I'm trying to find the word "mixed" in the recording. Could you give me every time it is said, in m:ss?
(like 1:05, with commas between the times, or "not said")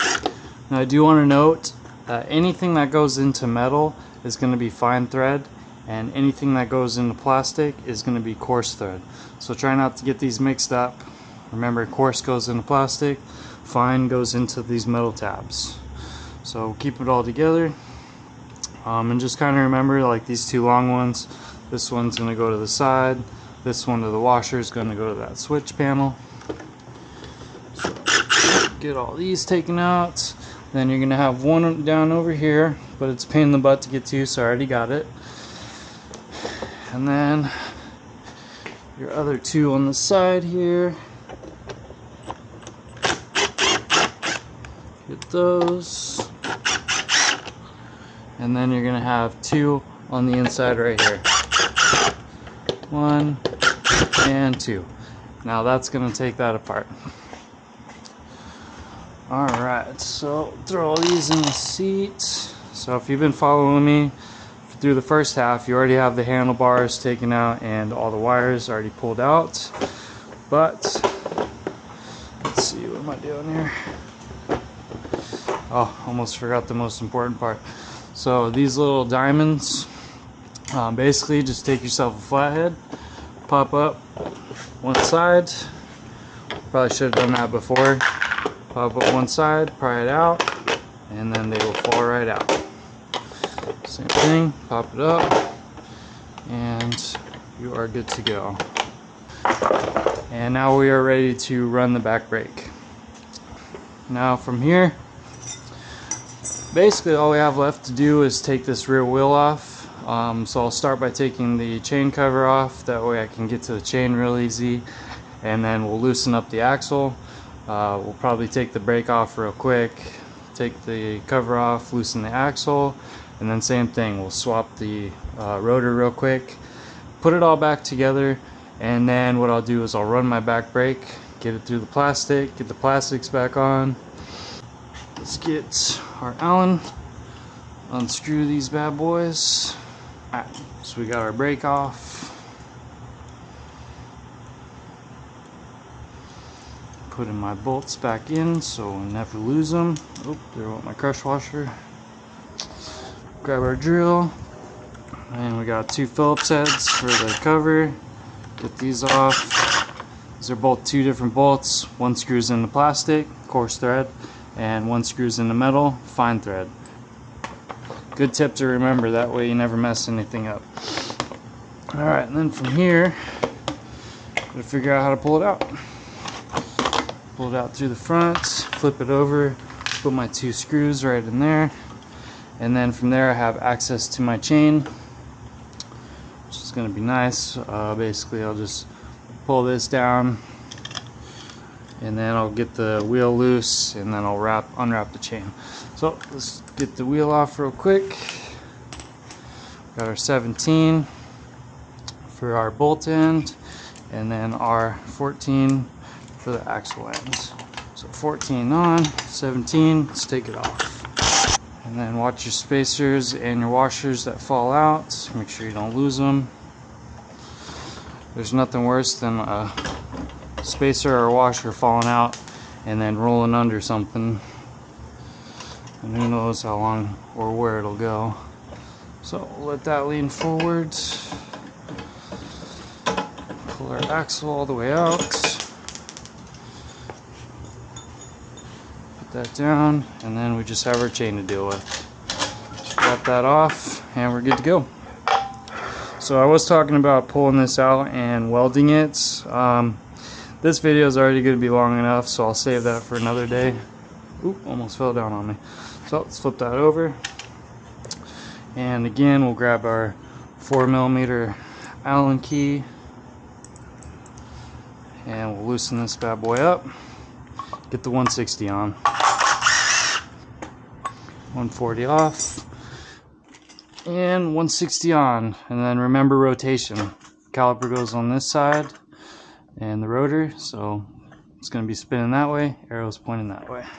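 0:10.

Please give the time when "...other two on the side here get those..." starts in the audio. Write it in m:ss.
0:39.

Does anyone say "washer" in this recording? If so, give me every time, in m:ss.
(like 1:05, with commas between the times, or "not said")
0:24, 2:31, 3:33, 3:41.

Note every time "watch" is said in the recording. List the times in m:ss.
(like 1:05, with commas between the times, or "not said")
3:32.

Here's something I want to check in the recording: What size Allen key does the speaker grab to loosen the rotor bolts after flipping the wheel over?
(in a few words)
4 millimeter.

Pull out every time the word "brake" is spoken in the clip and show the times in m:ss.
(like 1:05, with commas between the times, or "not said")
1:42, 1:58, 2:10, 2:21.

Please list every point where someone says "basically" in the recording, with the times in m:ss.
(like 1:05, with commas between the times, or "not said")
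1:20, 1:46, 3:07.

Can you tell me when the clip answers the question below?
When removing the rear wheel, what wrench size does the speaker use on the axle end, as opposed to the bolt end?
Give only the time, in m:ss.
3:25.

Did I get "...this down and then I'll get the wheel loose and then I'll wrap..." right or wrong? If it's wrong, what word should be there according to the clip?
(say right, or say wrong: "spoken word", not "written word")
right.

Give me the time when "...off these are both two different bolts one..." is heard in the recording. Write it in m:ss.
2:39.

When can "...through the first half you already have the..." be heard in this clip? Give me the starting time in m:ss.
1:04.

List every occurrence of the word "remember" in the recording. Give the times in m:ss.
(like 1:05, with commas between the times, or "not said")
0:11, 0:19, 2:48, 4:35.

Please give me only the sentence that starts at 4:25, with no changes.
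And we'll loosen this bad boy up.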